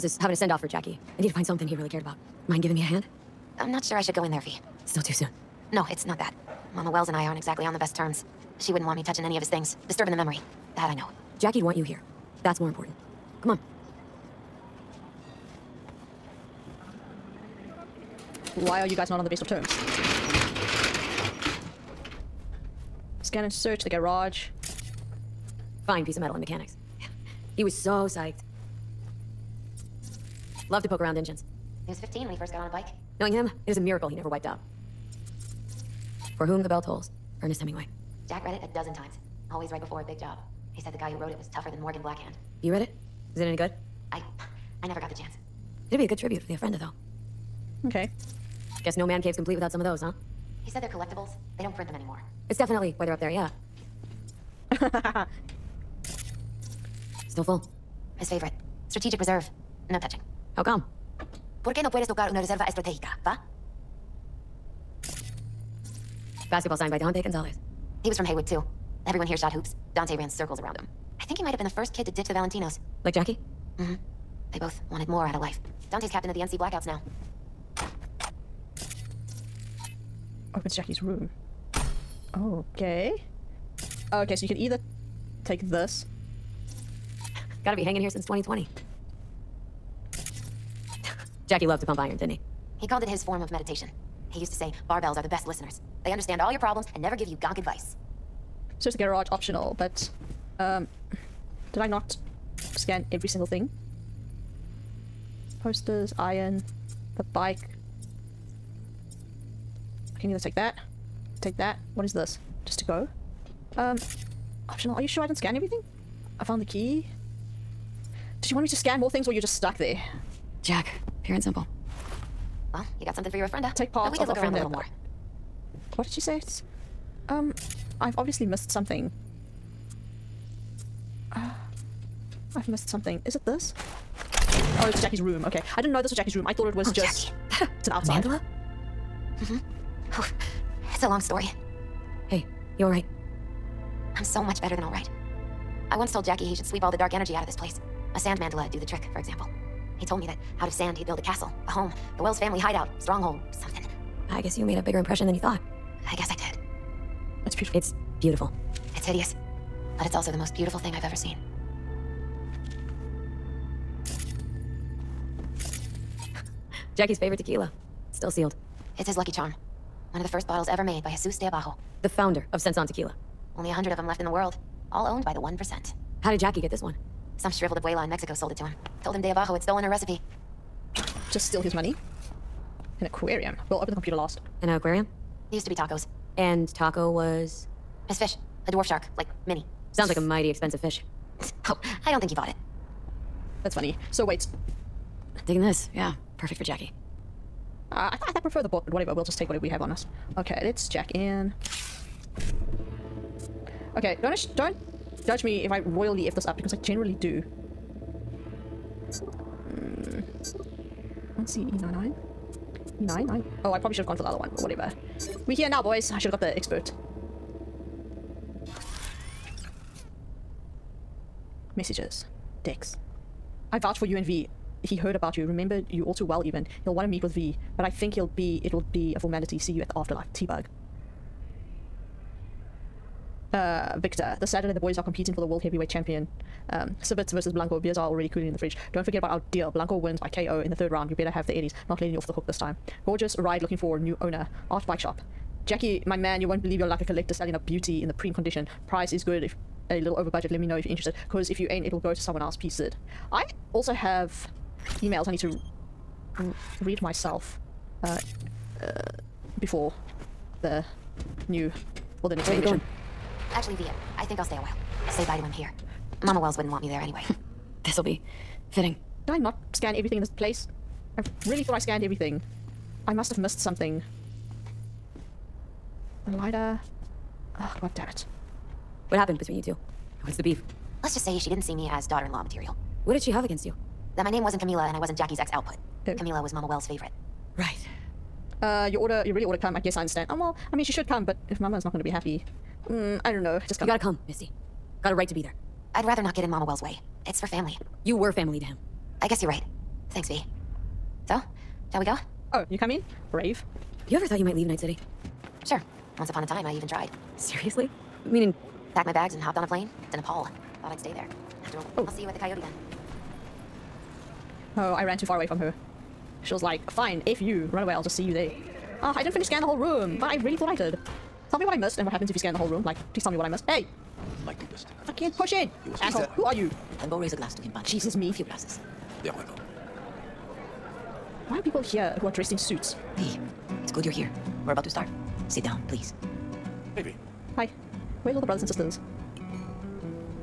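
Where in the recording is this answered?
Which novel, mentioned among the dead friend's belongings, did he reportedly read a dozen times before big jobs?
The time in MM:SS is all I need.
00:36.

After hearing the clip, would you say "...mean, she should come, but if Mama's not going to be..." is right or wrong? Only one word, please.
right.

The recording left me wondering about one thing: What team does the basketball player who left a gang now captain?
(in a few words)
NC Blackouts.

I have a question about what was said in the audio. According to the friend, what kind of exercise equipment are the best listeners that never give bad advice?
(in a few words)
Barbells.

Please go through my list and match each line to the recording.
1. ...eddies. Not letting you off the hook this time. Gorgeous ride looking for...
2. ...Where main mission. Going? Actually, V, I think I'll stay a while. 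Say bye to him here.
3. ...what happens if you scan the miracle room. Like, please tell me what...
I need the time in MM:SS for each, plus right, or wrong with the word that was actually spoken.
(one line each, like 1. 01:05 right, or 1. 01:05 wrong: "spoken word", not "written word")
1. 04:01 right
2. 04:22 right
3. 05:22 wrong: "whole", not "miracle".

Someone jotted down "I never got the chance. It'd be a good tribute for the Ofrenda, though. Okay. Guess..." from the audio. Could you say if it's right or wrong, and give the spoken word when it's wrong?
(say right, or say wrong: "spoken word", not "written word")
right.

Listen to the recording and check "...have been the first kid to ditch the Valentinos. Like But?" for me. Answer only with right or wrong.
wrong.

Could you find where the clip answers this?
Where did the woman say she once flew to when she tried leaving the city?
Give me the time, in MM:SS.
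05:10.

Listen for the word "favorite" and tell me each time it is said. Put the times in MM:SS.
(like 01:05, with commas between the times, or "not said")
00:58, 02:47, 04:46.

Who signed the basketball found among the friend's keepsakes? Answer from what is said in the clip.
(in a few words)
Dante Gonzalez.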